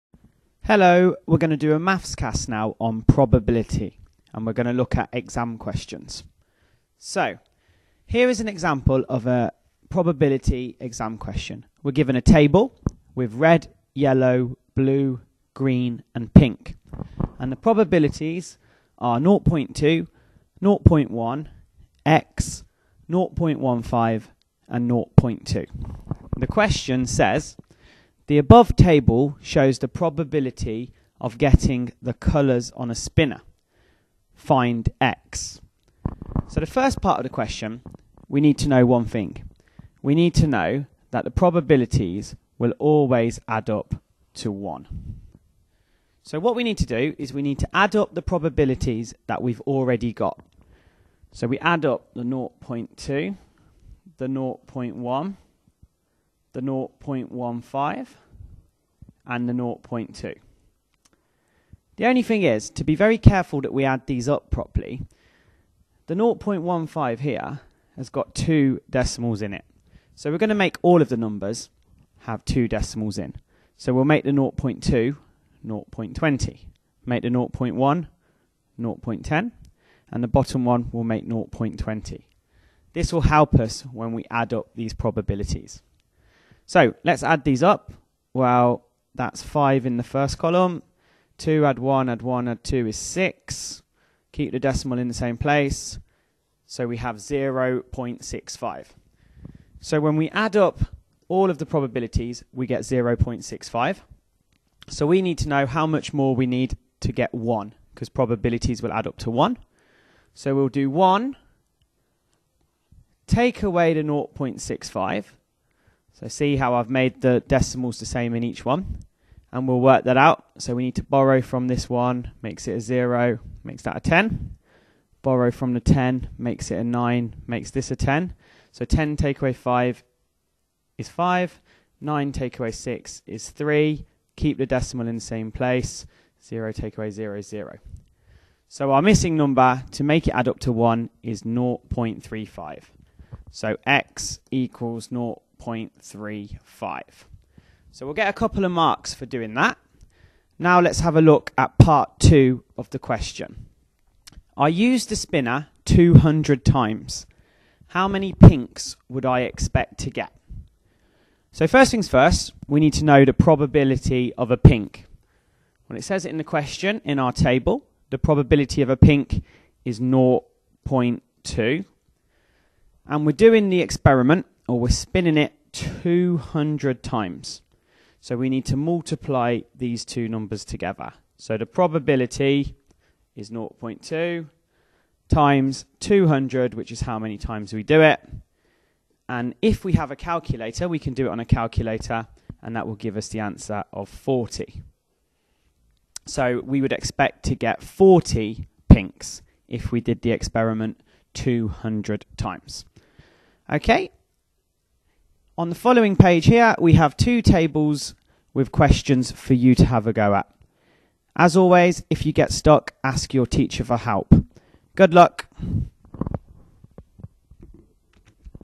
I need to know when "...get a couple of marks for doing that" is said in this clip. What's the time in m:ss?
2:28.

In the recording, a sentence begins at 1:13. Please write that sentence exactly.
So we'll make the 0.2 0.20, make the 0.1 0.10, and the bottom one will make 0.20.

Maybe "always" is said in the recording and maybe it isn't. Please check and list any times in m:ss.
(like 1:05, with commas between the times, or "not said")
0:42, 3:31.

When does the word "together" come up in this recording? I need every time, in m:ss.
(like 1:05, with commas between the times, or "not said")
3:00.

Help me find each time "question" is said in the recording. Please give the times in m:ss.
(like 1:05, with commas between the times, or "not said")
0:05, 0:11, 0:26, 0:37, 2:32, 2:46, 3:28.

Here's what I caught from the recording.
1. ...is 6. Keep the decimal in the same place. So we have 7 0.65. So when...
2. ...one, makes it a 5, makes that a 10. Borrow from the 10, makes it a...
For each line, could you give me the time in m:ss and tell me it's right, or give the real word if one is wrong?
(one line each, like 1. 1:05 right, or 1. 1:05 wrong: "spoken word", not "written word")
1. 1:32 wrong: "0", not "7"
2. 2:01 wrong: "0", not "5".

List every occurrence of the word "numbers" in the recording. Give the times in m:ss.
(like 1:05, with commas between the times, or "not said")
1:11, 2:19, 3:00.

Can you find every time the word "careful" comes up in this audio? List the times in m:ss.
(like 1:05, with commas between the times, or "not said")
1:03.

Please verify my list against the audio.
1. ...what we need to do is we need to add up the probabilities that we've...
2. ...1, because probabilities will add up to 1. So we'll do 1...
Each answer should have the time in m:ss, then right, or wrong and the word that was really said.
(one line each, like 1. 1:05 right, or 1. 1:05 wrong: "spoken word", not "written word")
1. 0:46 right
2. 1:47 right.